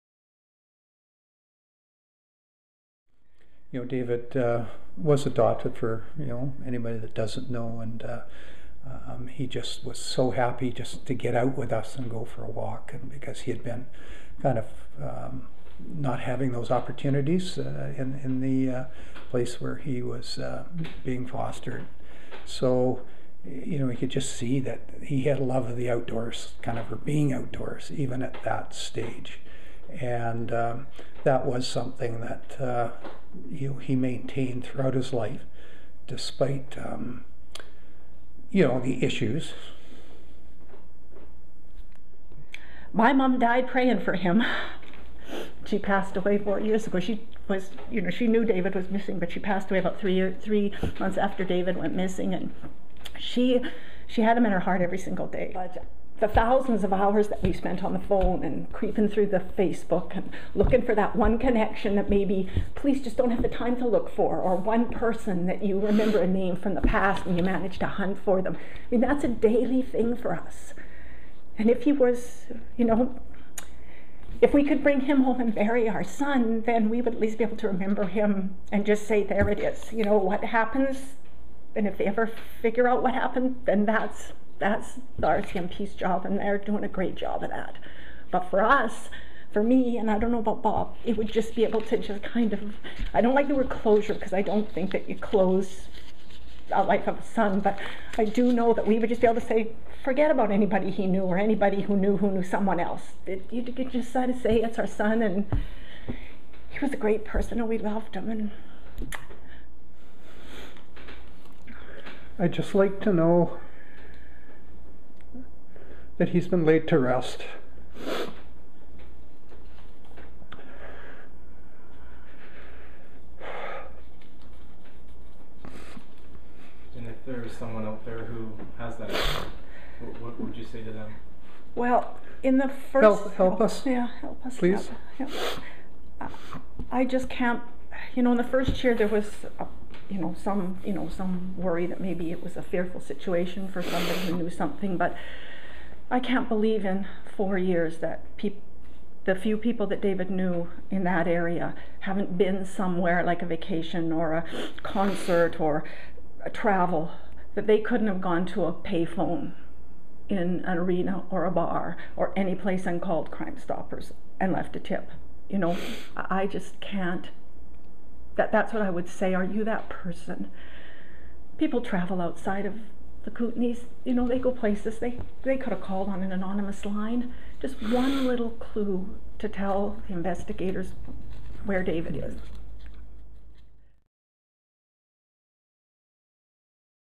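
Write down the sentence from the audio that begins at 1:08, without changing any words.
I mean, that's a daily thing for us.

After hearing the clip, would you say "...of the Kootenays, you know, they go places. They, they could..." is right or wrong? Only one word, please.
right.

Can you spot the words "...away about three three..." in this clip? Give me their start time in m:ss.
0:49.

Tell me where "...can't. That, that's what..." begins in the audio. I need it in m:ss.
2:46.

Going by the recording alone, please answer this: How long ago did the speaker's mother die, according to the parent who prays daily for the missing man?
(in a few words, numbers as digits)
4 years.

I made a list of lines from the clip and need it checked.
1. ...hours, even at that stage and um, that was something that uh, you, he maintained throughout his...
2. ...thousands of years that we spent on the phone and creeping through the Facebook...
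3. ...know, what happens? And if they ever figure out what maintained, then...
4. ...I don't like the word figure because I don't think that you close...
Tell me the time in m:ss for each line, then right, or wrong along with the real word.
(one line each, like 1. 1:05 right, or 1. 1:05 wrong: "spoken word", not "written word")
1. 0:27 wrong: "outdoors", not "hours"
2. 0:56 wrong: "hours", not "years"
3. 1:20 wrong: "happened", not "maintained"
4. 1:33 wrong: "closure", not "figure".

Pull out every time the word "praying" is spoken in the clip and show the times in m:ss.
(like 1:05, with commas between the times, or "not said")
0:43.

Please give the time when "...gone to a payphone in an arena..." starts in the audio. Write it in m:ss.
2:38.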